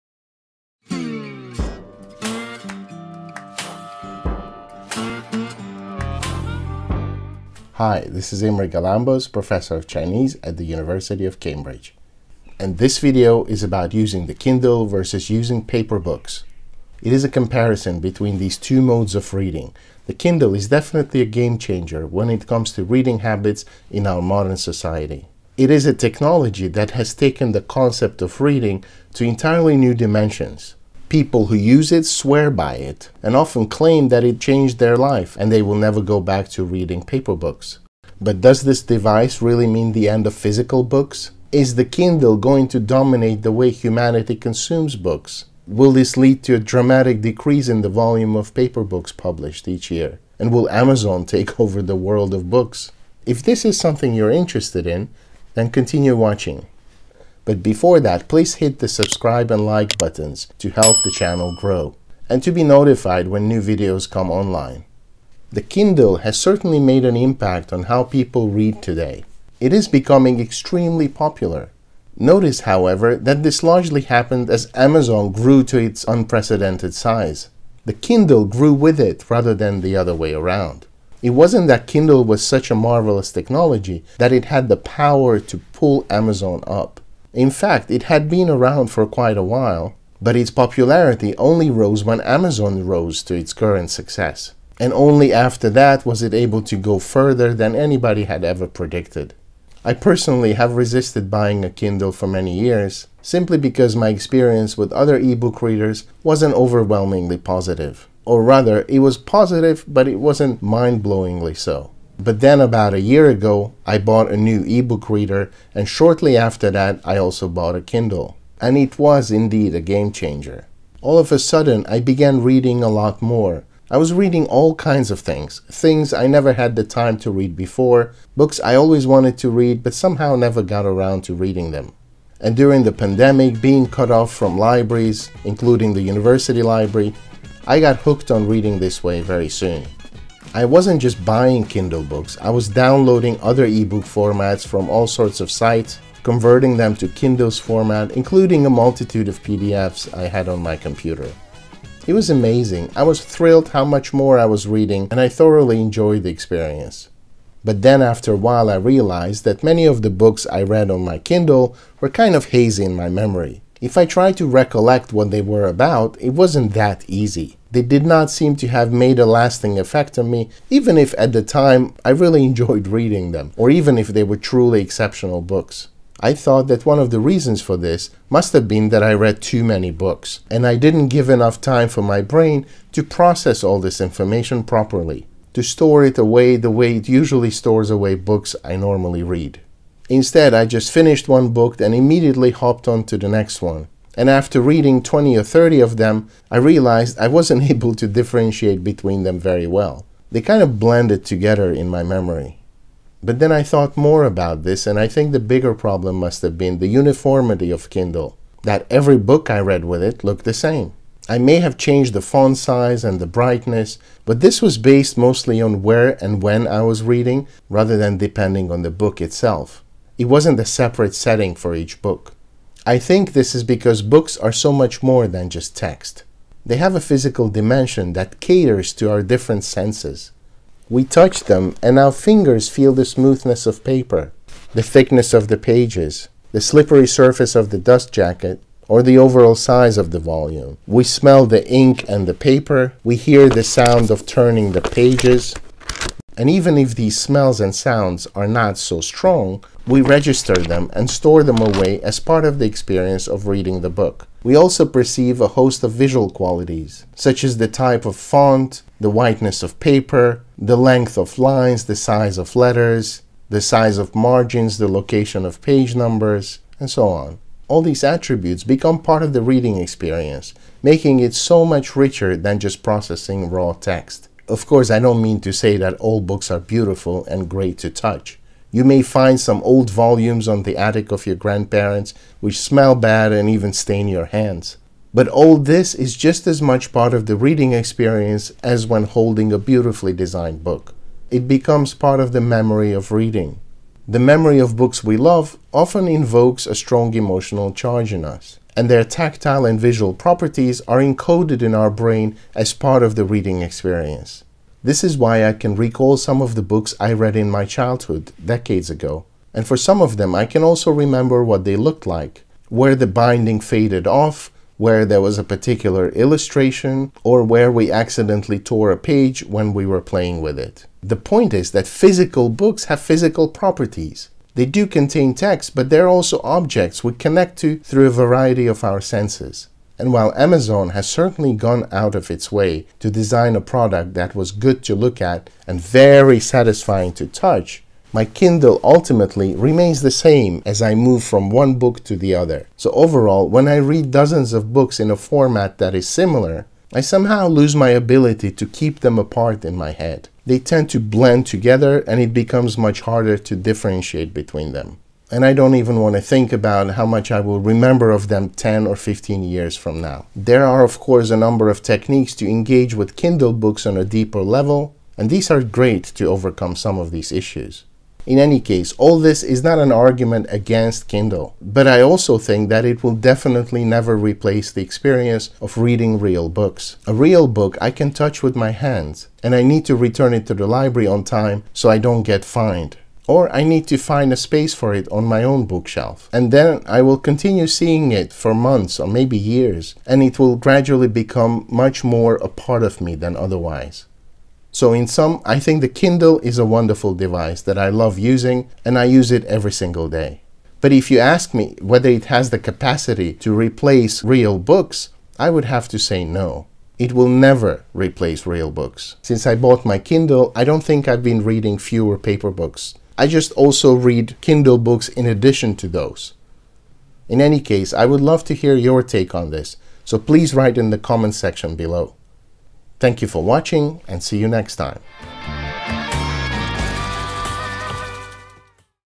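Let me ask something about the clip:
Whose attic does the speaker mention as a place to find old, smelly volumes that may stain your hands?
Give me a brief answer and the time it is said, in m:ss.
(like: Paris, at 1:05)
grandparents, at 4:41.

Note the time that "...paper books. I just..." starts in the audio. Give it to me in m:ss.
6:52.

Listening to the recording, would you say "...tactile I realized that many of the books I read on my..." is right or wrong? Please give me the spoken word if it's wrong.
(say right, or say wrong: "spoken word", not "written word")
wrong: "while", not "tactile".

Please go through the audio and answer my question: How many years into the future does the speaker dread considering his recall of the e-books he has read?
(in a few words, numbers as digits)
10 or 15.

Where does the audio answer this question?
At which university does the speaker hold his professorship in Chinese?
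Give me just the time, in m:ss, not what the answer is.
0:10.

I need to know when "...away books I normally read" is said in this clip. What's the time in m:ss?
3:07.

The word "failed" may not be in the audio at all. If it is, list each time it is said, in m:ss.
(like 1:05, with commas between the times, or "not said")
not said.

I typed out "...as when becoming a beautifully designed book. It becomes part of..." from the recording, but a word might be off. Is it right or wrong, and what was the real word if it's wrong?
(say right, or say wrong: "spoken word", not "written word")
wrong: "holding", not "becoming".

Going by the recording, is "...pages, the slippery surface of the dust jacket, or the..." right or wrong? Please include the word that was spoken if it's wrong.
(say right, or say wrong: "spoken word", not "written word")
right.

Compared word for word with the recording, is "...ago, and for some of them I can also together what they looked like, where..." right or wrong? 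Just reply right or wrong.
wrong.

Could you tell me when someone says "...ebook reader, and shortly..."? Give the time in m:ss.
1:54.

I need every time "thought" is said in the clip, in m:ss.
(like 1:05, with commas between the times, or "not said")
2:56, 3:23.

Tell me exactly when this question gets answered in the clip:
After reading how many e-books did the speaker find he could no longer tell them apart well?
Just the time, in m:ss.
3:15.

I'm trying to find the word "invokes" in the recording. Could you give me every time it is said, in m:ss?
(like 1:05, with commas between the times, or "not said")
4:56.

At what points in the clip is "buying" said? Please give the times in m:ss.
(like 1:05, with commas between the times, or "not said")
1:41, 2:21.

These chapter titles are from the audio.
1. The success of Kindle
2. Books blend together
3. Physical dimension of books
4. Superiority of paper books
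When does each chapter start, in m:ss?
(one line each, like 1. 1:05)
1. 1:05
2. 2:37
3. 3:42
4. 4:53.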